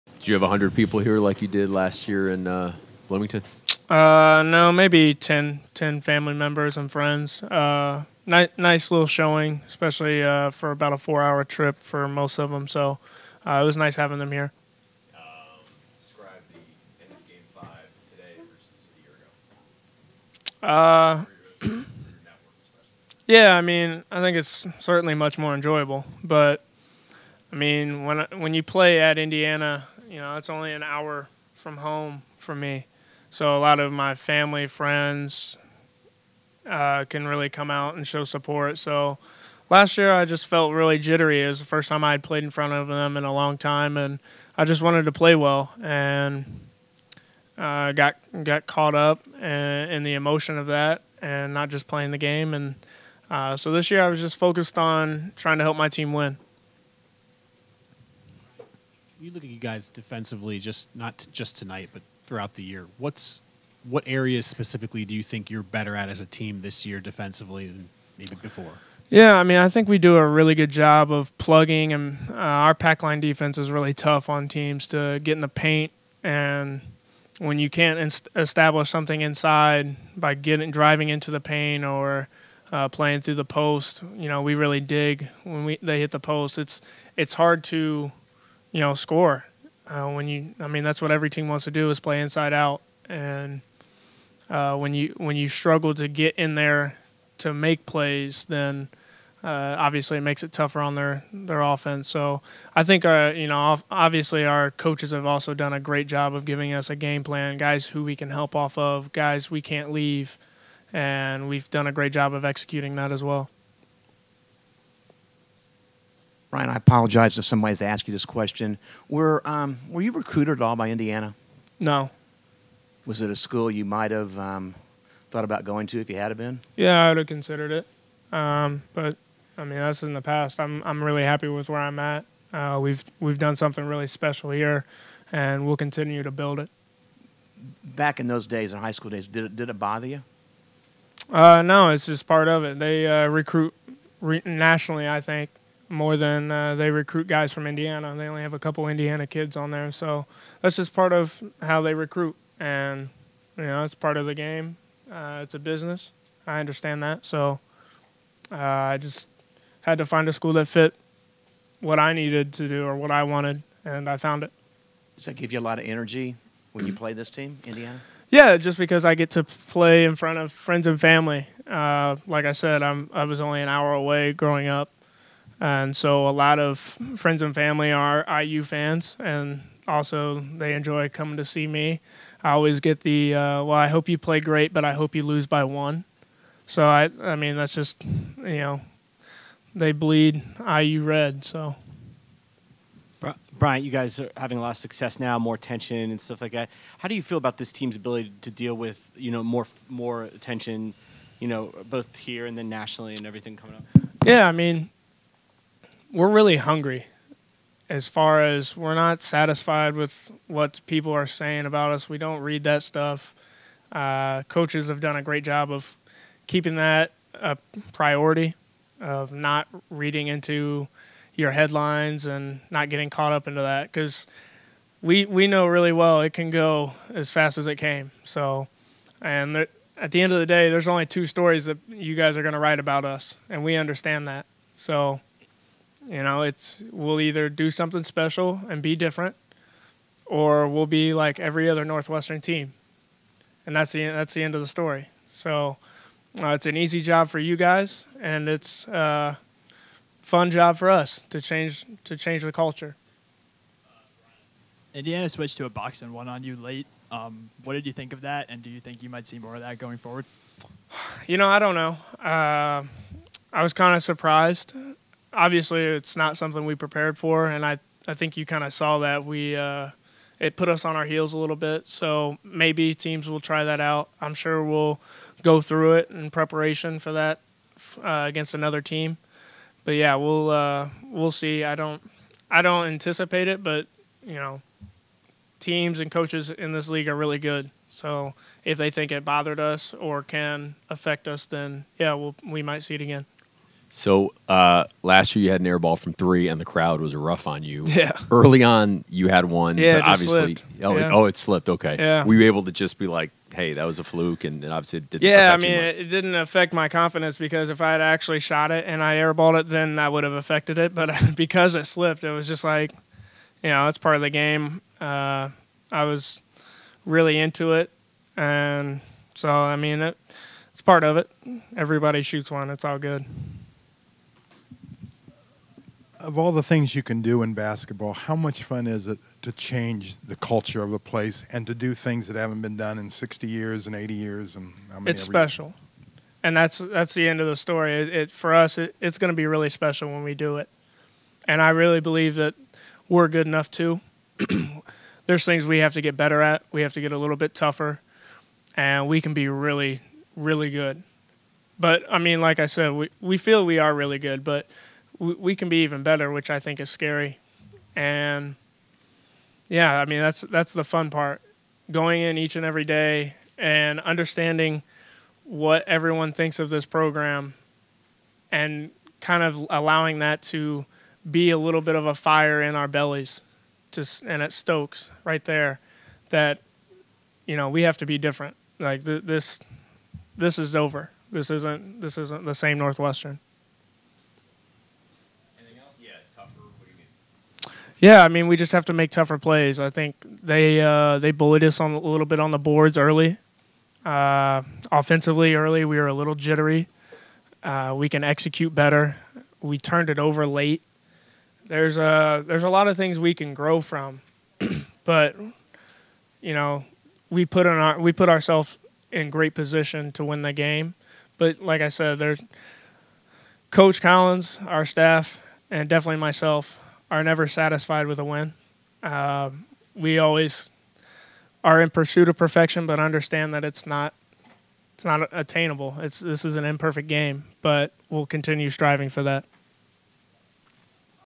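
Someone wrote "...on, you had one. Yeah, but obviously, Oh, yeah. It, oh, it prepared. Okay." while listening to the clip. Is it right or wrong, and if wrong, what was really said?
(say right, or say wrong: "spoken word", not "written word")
wrong: "slipped", not "prepared".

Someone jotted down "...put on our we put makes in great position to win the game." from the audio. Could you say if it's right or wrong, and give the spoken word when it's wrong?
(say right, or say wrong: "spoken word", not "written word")
wrong: "ourselves", not "makes".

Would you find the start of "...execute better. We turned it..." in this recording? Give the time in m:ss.
6:38.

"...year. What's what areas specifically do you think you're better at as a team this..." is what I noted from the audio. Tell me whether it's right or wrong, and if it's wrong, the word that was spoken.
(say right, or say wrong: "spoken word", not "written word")
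right.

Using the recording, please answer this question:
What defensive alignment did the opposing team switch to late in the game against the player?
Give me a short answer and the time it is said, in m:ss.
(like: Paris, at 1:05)
box and one, at 4:15.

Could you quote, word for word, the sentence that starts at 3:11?
So, Bryant, you guys are having a lot of success now, more tension and stuff like that.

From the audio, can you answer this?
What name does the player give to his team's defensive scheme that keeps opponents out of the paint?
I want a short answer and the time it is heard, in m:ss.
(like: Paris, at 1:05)
pack line defense, at 1:12.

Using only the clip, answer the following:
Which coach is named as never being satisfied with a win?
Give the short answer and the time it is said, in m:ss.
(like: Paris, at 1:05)
Coach Collins, at 6:53.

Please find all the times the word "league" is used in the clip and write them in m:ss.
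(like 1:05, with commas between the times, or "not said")
4:46.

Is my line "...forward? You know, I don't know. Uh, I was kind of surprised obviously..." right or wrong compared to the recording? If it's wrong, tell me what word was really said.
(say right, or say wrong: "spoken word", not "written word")
right.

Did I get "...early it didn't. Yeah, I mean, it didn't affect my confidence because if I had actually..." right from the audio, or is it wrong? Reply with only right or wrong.
wrong.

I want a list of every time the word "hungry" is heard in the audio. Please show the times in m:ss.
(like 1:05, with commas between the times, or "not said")
3:26.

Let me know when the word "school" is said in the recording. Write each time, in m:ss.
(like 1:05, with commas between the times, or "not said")
2:03, 2:18, 2:40.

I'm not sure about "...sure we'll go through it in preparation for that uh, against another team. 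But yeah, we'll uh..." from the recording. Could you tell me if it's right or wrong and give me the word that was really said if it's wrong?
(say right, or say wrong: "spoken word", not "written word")
right.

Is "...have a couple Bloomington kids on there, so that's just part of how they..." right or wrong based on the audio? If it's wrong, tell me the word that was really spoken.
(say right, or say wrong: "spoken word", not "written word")
wrong: "Indiana", not "Bloomington".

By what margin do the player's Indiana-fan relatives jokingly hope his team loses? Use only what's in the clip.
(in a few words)
by one.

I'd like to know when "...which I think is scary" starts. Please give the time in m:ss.
5:56.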